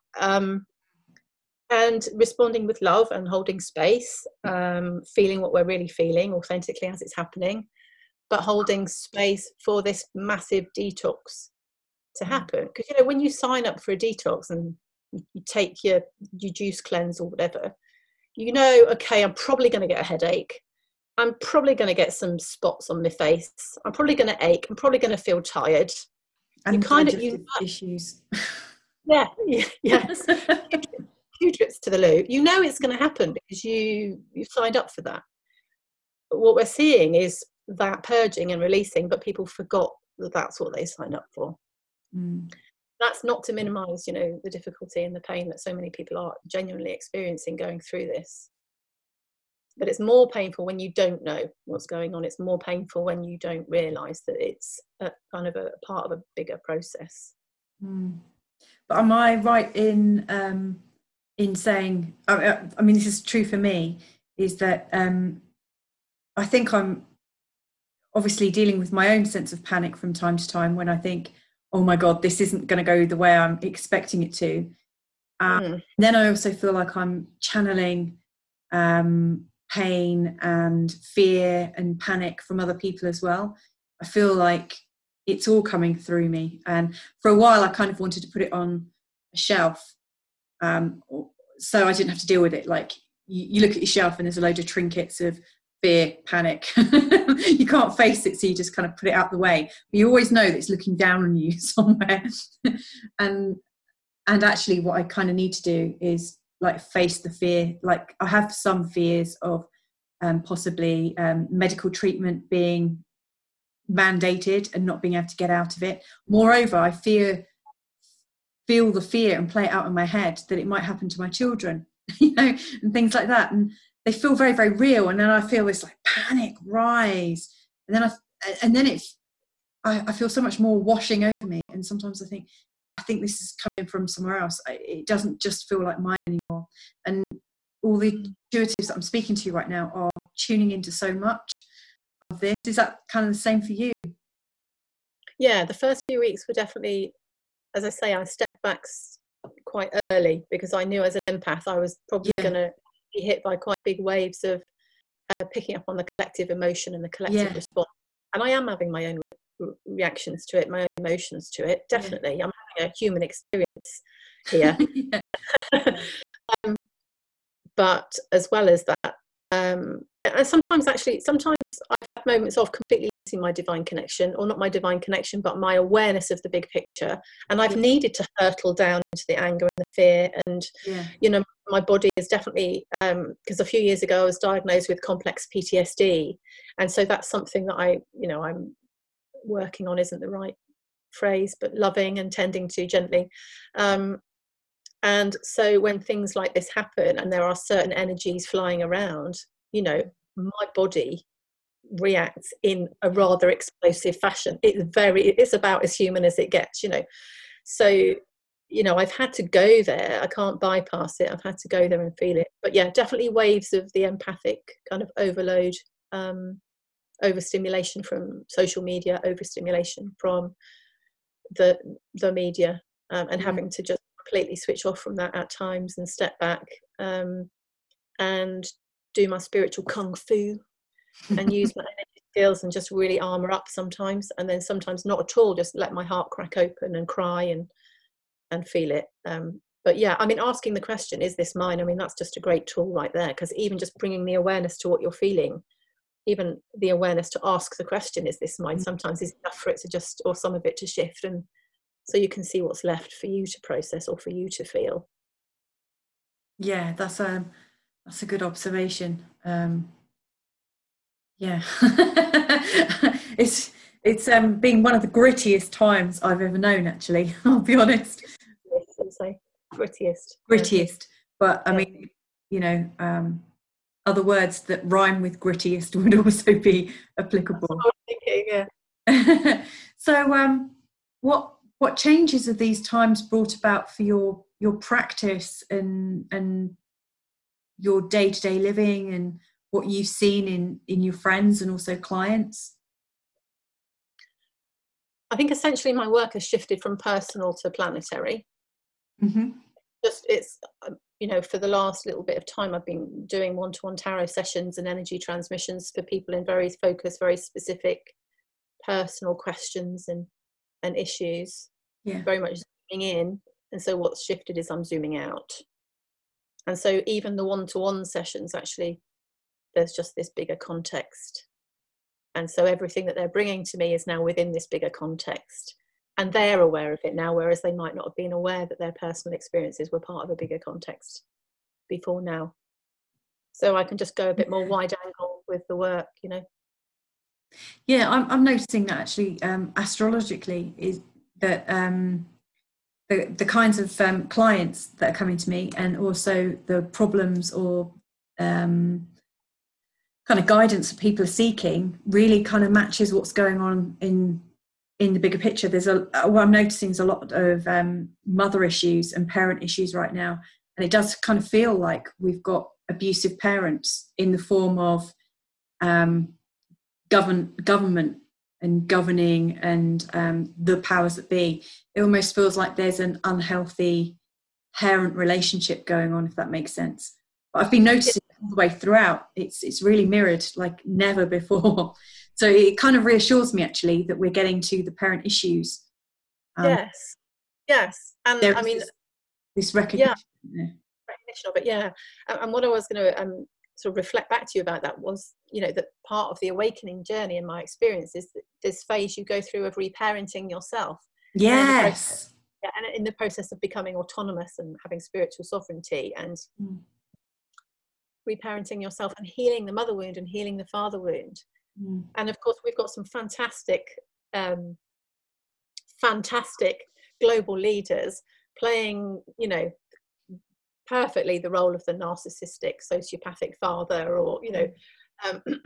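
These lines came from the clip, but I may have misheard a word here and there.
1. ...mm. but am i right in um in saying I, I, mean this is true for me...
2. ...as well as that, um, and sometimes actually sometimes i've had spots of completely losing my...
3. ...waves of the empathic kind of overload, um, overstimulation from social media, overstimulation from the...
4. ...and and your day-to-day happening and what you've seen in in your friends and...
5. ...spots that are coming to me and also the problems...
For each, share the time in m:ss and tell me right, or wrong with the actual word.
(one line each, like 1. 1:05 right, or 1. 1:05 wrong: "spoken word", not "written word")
1. 0:57 right
2. 2:48 wrong: "moments", not "spots"
3. 3:33 right
4. 4:45 wrong: "living", not "happening"
5. 5:44 wrong: "clients", not "spots".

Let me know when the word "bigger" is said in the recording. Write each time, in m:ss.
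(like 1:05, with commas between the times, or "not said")
0:56, 5:20, 5:24, 5:30, 5:55.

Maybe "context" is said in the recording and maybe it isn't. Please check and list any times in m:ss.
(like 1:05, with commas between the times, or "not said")
5:20, 5:24, 5:30.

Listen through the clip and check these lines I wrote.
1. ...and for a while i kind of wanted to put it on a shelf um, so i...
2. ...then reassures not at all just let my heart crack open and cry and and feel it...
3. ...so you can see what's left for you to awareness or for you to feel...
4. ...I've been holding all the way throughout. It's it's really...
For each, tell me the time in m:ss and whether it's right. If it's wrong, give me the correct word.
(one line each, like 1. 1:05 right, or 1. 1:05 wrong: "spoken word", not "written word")
1. 1:26 right
2. 3:54 wrong: "sometimes", not "reassures"
3. 4:12 wrong: "process", not "awareness"
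4. 6:17 wrong: "noticing", not "holding".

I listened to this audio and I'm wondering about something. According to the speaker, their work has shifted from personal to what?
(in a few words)
planetary.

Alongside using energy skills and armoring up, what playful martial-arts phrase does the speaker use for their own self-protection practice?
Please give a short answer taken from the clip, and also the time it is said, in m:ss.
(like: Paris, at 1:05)
spiritual kung fu, at 3:49.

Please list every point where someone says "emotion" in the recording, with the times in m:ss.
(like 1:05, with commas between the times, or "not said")
2:36, 2:40.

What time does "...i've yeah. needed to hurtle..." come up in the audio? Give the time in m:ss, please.
2:57.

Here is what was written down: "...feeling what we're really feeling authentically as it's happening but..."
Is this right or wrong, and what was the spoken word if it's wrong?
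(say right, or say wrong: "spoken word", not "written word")
right.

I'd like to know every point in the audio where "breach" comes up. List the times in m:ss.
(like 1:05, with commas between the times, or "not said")
not said.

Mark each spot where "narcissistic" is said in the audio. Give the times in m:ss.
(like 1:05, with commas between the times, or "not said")
7:01.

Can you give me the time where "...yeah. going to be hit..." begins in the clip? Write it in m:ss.
2:32.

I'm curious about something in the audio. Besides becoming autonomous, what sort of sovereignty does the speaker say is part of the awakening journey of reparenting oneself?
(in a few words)
spiritual sovereignty.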